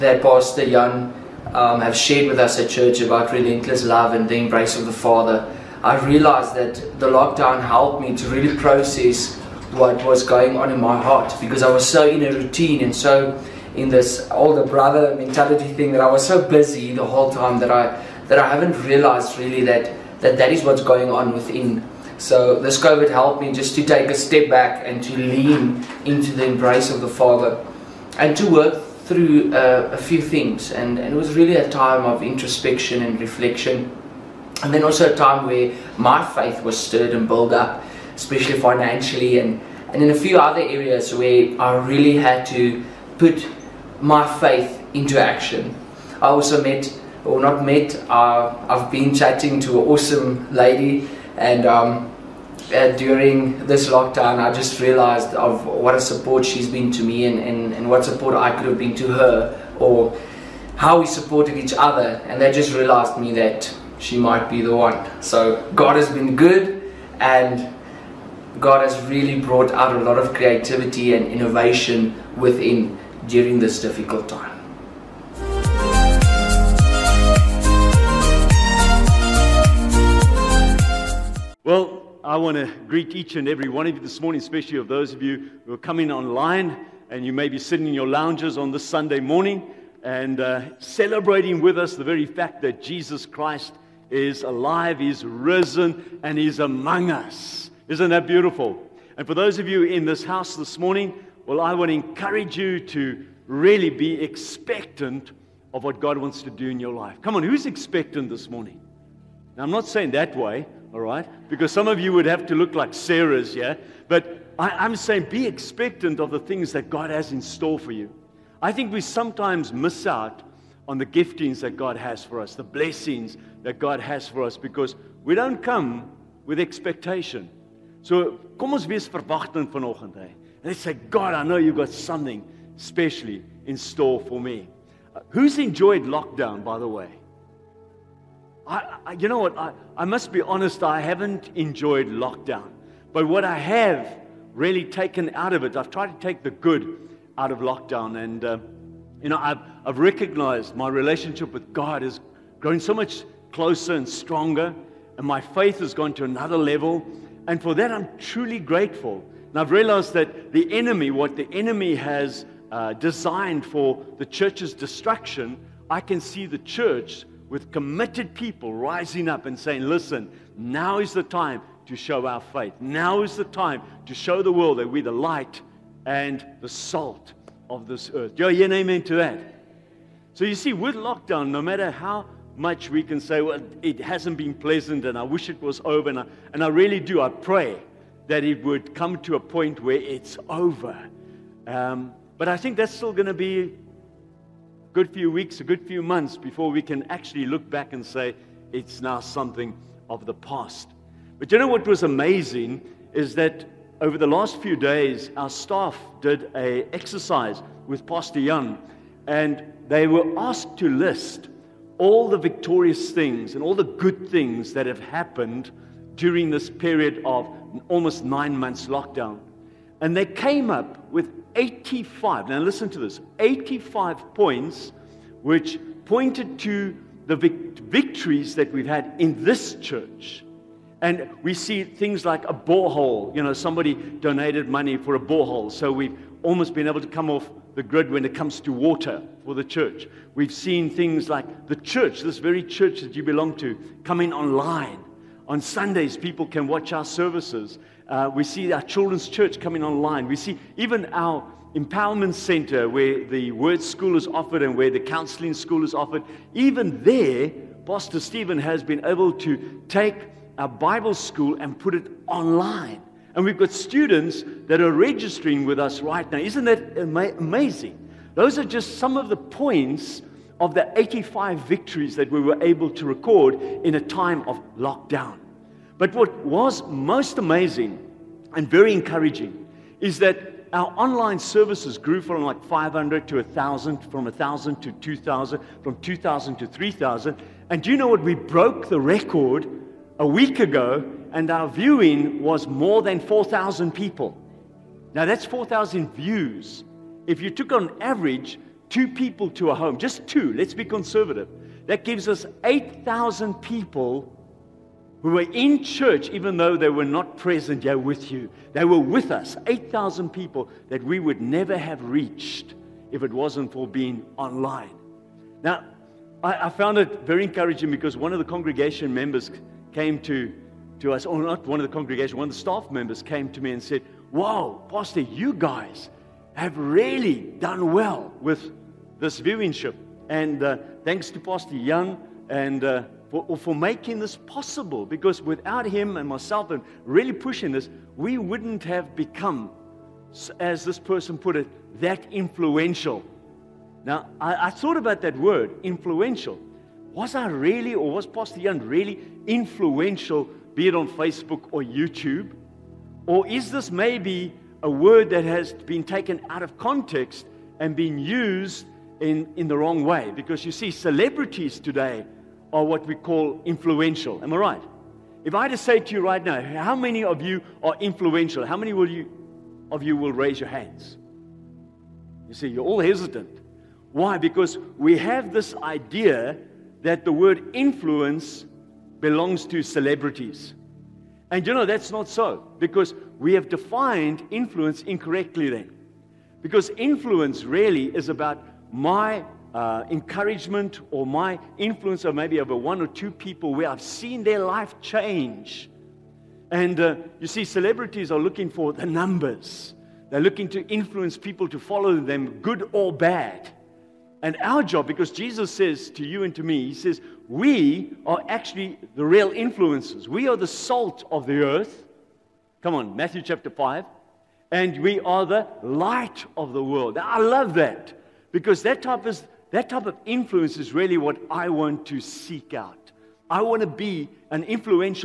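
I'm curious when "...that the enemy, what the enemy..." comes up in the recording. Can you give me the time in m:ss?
2:40.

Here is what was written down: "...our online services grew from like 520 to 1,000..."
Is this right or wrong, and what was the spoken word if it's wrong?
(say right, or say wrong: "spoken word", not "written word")
wrong: "500", not "520".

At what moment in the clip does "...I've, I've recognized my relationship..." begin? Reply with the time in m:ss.
2:29.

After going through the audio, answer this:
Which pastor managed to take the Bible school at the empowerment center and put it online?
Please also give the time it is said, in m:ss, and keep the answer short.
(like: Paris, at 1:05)
Pastor Stephen, at 4:17.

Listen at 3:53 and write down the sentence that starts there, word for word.
You know, somebody donated money for a borehole.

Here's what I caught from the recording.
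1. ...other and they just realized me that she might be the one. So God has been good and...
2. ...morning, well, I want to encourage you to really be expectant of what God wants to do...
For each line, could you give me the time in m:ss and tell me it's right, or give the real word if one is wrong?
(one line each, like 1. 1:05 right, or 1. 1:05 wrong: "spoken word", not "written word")
1. 1:01 right
2. 1:40 right.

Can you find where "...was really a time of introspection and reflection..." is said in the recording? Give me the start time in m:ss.
0:31.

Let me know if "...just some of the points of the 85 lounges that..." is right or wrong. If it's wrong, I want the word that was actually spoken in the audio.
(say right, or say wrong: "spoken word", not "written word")
wrong: "victories", not "lounges".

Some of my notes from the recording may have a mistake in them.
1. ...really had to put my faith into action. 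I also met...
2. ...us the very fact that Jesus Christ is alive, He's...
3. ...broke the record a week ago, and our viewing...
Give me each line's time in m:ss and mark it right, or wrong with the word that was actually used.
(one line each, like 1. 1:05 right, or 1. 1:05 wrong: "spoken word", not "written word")
1. 0:41 right
2. 1:31 right
3. 4:48 right.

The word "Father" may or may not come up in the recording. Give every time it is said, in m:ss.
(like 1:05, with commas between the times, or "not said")
0:04, 0:27.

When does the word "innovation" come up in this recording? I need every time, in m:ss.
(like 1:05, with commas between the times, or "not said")
1:11.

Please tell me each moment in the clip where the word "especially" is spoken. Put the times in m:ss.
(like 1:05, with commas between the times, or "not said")
0:38, 1:24.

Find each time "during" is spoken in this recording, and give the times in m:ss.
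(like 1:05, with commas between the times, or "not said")
0:52, 1:13, 3:36.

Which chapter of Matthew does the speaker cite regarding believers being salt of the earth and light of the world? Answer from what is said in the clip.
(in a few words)
Matthew chapter 5.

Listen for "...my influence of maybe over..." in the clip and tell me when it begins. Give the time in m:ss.
6:31.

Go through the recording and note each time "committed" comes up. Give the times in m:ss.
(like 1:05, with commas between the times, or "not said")
2:47.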